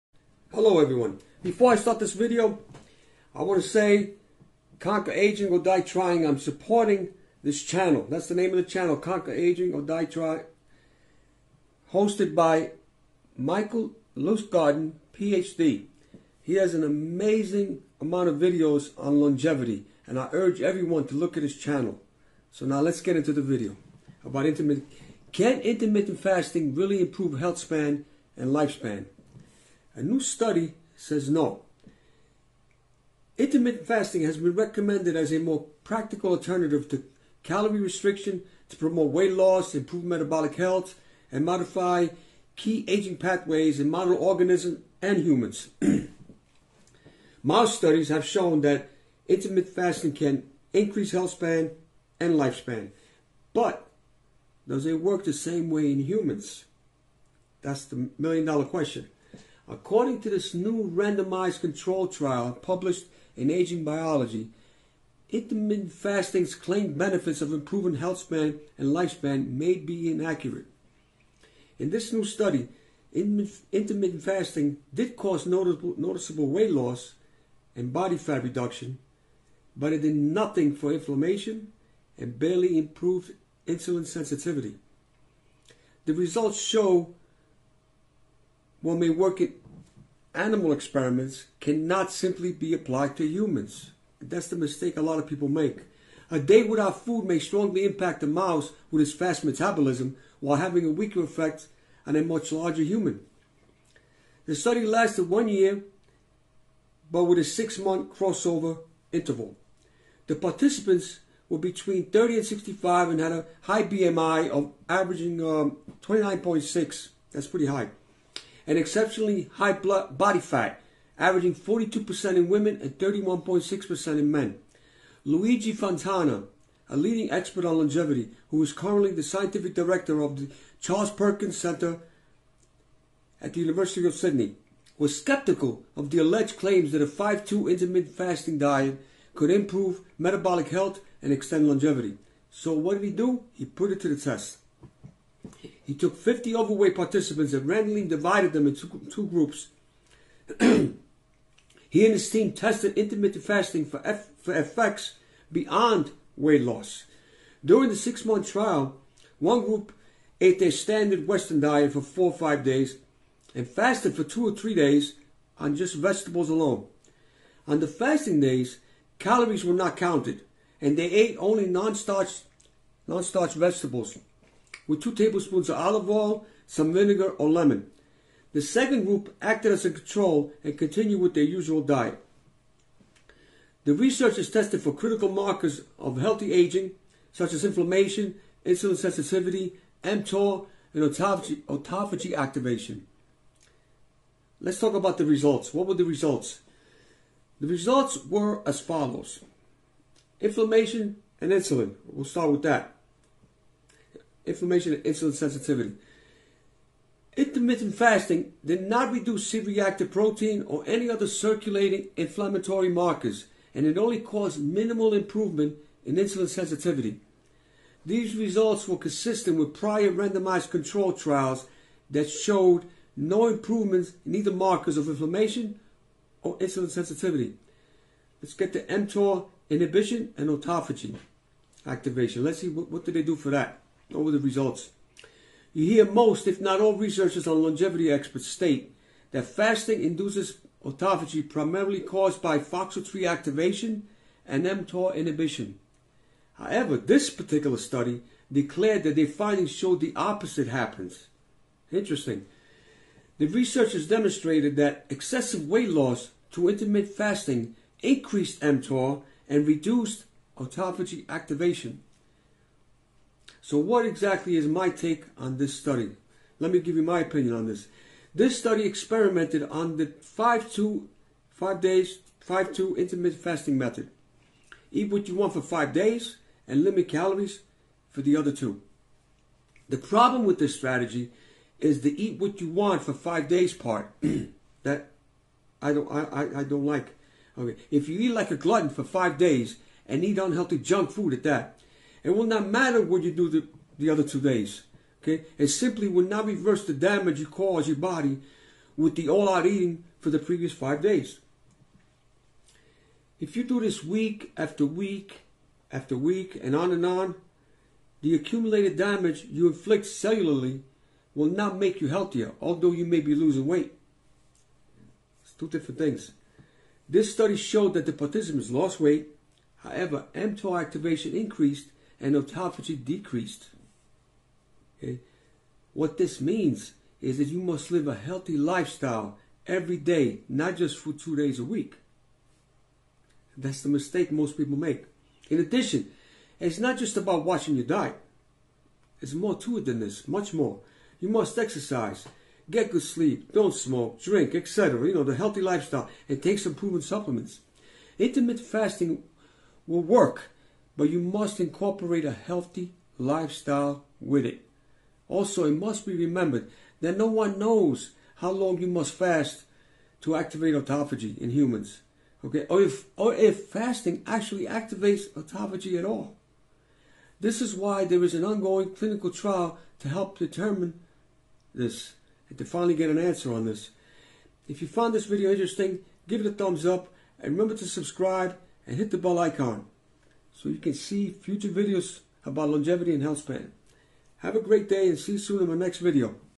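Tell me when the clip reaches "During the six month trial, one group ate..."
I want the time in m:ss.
2:37.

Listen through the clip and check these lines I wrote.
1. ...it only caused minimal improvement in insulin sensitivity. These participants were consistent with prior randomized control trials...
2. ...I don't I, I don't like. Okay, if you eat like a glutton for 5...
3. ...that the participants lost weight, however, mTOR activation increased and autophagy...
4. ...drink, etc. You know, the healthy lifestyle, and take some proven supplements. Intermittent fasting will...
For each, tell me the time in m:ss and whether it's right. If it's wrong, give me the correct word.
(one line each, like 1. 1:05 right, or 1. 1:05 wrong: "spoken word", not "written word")
1. 3:33 wrong: "results", not "participants"
2. 4:45 right
3. 5:17 right
4. 5:44 right.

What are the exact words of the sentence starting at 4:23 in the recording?
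So what exactly is my take on this study?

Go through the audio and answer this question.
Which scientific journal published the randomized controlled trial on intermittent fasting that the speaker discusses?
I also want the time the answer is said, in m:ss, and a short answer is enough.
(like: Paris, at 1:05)
Aging Biology, at 1:03.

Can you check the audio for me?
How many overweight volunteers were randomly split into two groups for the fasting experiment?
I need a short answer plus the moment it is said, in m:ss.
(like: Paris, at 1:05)
50, at 2:26.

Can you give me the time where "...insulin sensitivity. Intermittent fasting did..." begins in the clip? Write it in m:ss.
3:25.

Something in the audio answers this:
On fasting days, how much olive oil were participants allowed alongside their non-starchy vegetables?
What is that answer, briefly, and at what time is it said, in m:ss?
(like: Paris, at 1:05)
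2 tablespoons, at 2:55.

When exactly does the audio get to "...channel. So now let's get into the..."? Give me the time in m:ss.
0:21.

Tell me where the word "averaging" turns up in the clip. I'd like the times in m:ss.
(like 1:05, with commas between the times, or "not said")
1:54, 2:01.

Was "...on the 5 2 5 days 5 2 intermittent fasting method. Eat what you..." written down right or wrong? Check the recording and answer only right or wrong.
right.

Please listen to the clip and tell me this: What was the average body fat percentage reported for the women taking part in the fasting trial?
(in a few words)
42%.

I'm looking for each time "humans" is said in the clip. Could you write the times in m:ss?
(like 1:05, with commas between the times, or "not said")
0:45, 0:56, 1:33, 1:42, 6:01.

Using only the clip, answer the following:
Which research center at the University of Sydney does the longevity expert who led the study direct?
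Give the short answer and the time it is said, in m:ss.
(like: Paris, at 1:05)
Charles Perkins Center, at 2:10.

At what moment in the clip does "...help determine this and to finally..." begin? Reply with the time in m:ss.
6:10.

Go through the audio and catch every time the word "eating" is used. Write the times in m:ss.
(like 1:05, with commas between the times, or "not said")
4:59.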